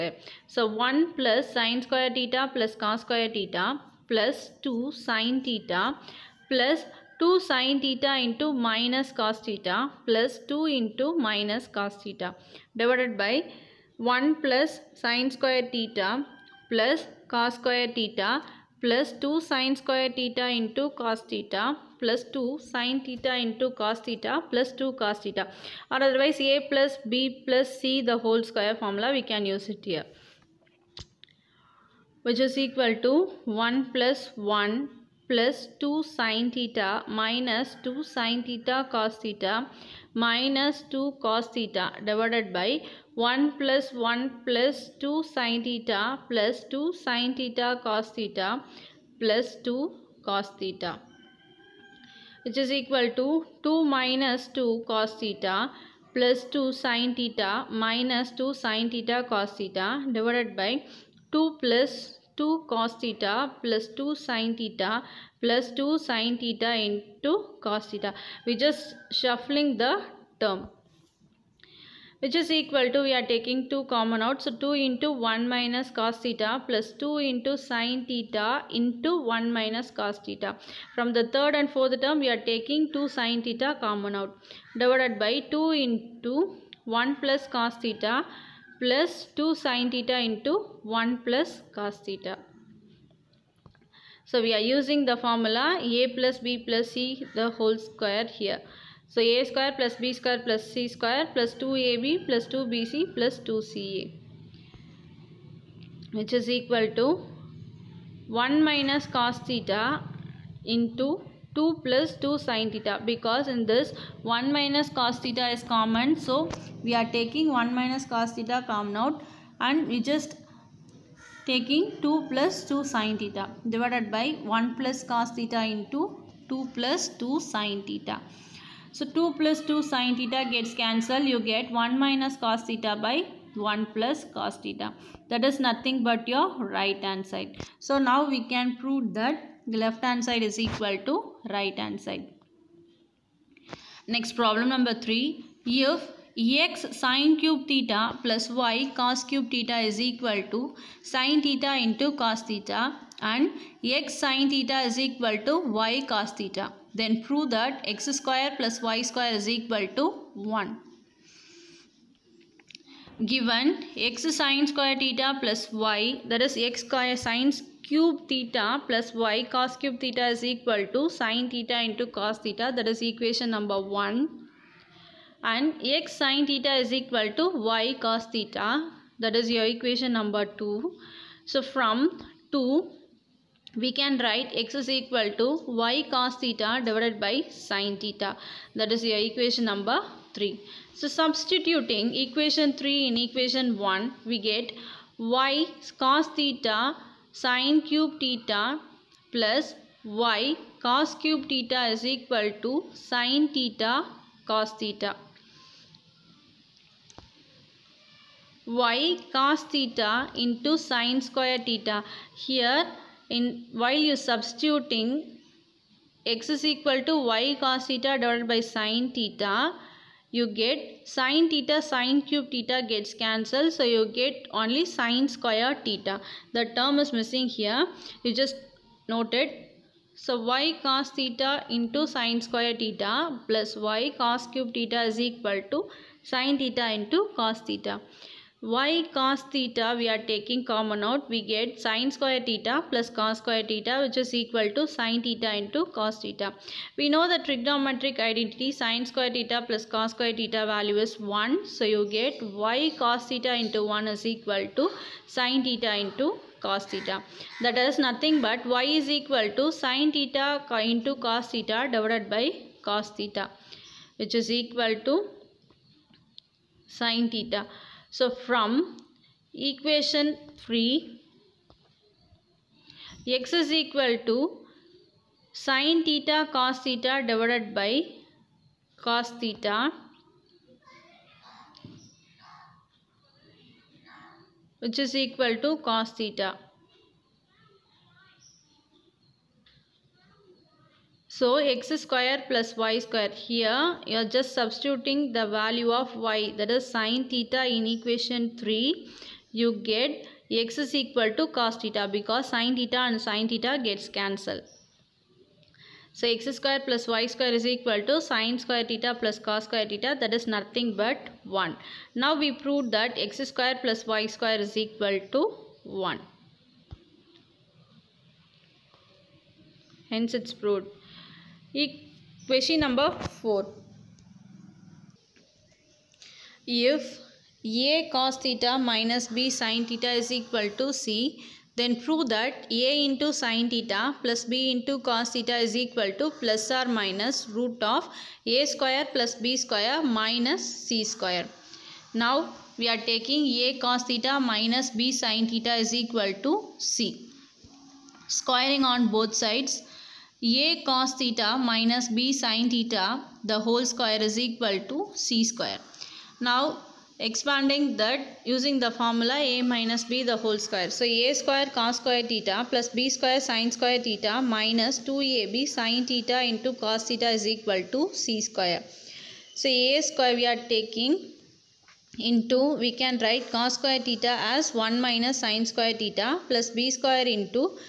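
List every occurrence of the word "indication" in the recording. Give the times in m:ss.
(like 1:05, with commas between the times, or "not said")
not said.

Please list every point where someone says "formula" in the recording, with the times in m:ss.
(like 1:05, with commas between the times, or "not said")
1:35, 5:58.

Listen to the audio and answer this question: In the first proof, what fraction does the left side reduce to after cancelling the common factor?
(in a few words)
1 - cos θ / 1 + cos θ.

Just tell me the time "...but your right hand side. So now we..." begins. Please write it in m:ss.
2:16.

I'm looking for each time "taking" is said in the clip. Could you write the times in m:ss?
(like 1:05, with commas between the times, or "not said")
1:13, 1:22, 1:57, 2:01, 4:00, 6:10.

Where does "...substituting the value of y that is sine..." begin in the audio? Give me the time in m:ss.
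4:54.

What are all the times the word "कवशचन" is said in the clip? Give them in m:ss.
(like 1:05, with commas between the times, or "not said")
5:21.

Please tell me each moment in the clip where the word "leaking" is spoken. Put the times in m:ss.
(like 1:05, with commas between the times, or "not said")
not said.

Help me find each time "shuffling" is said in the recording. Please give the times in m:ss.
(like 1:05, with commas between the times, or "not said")
1:09.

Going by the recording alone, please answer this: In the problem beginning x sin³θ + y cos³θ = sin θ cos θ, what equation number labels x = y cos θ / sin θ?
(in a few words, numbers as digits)
3.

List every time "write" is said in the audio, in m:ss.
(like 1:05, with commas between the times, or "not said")
3:04, 6:13.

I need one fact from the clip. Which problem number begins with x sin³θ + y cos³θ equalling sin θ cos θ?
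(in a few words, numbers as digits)
3.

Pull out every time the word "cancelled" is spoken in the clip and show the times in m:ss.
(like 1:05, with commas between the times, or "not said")
2:10, 3:43, 5:04.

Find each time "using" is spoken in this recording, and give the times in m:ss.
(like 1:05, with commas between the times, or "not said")
1:34, 5:58.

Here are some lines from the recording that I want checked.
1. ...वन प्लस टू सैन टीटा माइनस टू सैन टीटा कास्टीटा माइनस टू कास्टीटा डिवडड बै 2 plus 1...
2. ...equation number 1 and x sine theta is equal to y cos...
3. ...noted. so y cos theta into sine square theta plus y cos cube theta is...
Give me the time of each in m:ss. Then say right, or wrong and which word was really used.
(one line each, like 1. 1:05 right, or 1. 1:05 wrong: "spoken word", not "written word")
1. 0:34 wrong: "1", not "2"
2. 2:53 right
3. 3:49 right.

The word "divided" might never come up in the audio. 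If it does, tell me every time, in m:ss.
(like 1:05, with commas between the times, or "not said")
0:12, 1:00, 1:24, 2:03, 3:06, 3:38, 4:21, 4:37.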